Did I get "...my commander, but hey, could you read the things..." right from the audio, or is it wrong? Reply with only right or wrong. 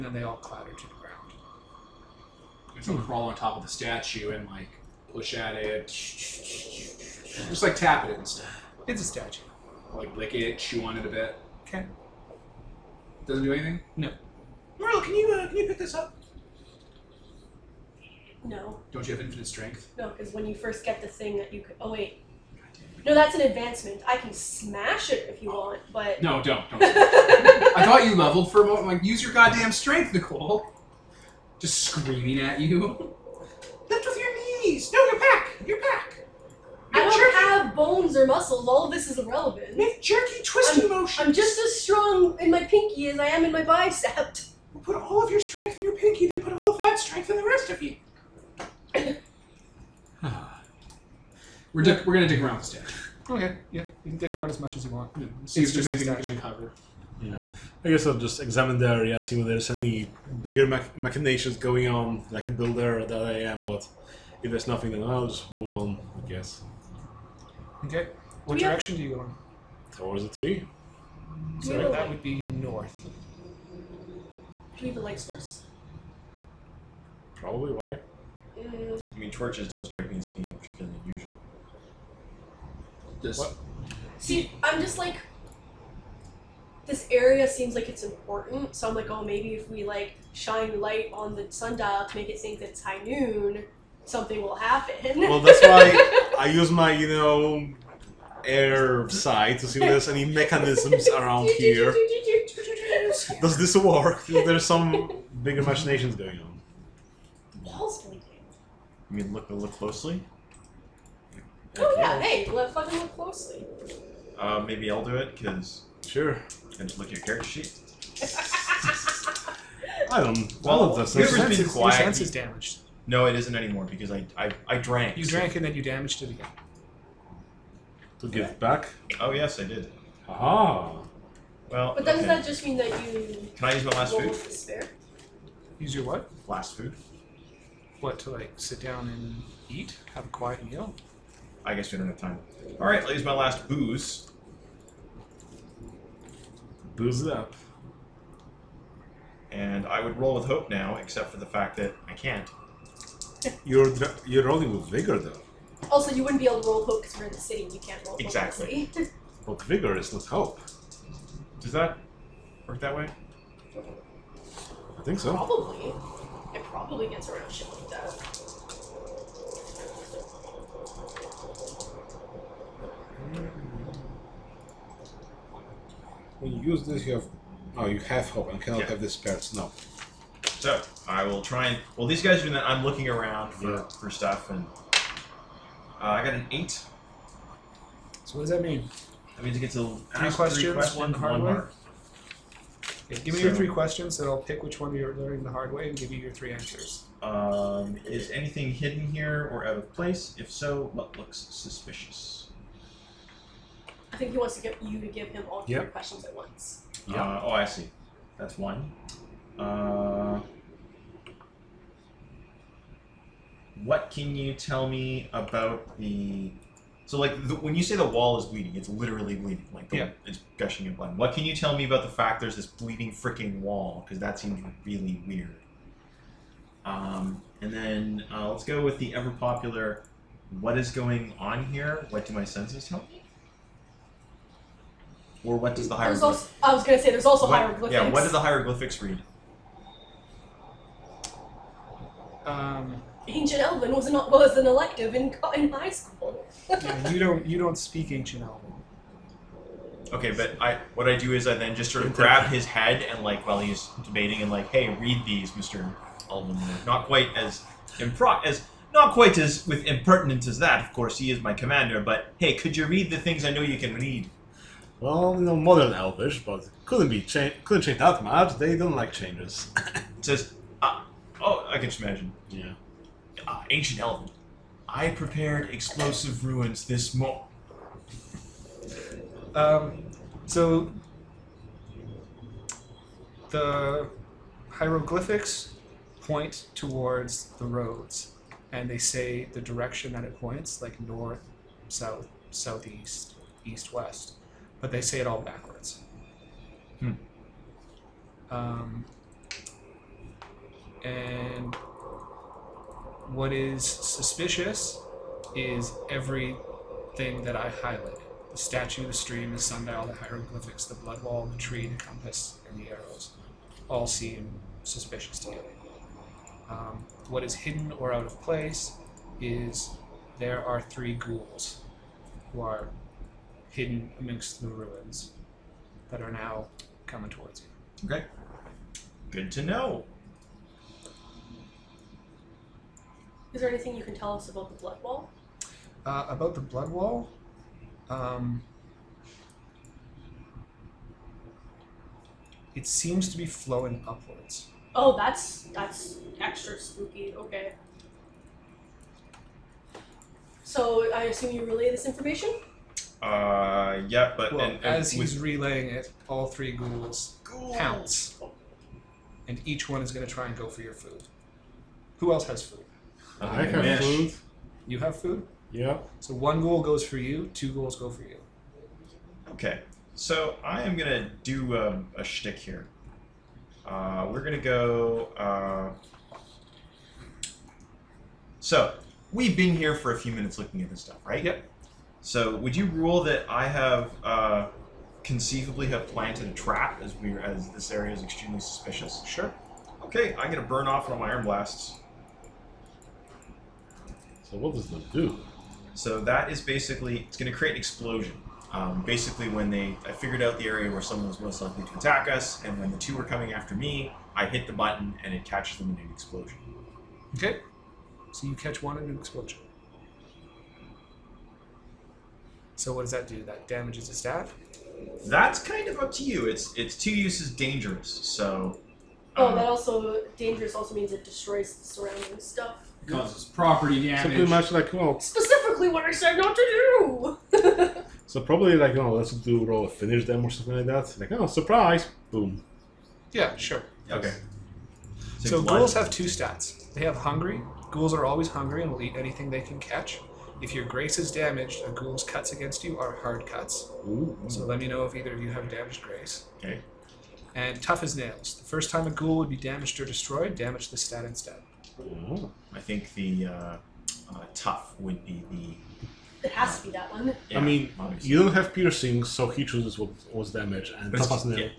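right.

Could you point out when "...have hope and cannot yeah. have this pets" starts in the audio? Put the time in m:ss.
2:57.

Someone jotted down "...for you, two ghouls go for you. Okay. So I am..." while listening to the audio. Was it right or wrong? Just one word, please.
right.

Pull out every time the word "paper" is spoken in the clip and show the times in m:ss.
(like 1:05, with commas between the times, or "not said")
not said.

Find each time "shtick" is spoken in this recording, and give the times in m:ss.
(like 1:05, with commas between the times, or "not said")
6:12.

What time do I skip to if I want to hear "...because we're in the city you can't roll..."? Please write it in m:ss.
2:37.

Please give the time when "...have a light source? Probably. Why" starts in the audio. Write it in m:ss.
1:14.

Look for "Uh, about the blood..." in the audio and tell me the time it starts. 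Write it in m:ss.
5:36.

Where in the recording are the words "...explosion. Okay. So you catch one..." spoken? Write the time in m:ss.
6:46.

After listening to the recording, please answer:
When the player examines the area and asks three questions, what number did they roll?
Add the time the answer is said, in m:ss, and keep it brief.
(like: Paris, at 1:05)
8, at 3:06.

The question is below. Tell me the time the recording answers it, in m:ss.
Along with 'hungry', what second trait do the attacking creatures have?
7:27.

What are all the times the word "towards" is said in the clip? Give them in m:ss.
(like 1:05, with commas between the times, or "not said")
1:09, 4:46, 5:27.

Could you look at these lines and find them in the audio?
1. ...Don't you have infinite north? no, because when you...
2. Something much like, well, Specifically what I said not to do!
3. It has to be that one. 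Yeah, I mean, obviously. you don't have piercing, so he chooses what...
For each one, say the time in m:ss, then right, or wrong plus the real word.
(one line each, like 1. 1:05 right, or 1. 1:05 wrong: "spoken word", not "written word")
1. 0:18 wrong: "strength", not "north"
2. 7:04 right
3. 7:36 right.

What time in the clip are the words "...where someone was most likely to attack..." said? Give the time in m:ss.
6:40.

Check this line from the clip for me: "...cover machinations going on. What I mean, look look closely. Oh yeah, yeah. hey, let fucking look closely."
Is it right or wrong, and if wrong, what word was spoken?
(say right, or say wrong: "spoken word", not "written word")
wrong: "bigger", not "cover".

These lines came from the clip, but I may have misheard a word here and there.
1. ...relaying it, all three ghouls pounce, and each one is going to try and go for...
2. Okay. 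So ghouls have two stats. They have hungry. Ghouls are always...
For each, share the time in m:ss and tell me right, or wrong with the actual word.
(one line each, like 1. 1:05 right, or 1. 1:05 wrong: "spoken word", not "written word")
1. 5:55 right
2. 7:14 right.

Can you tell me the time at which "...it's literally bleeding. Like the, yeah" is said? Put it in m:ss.
3:38.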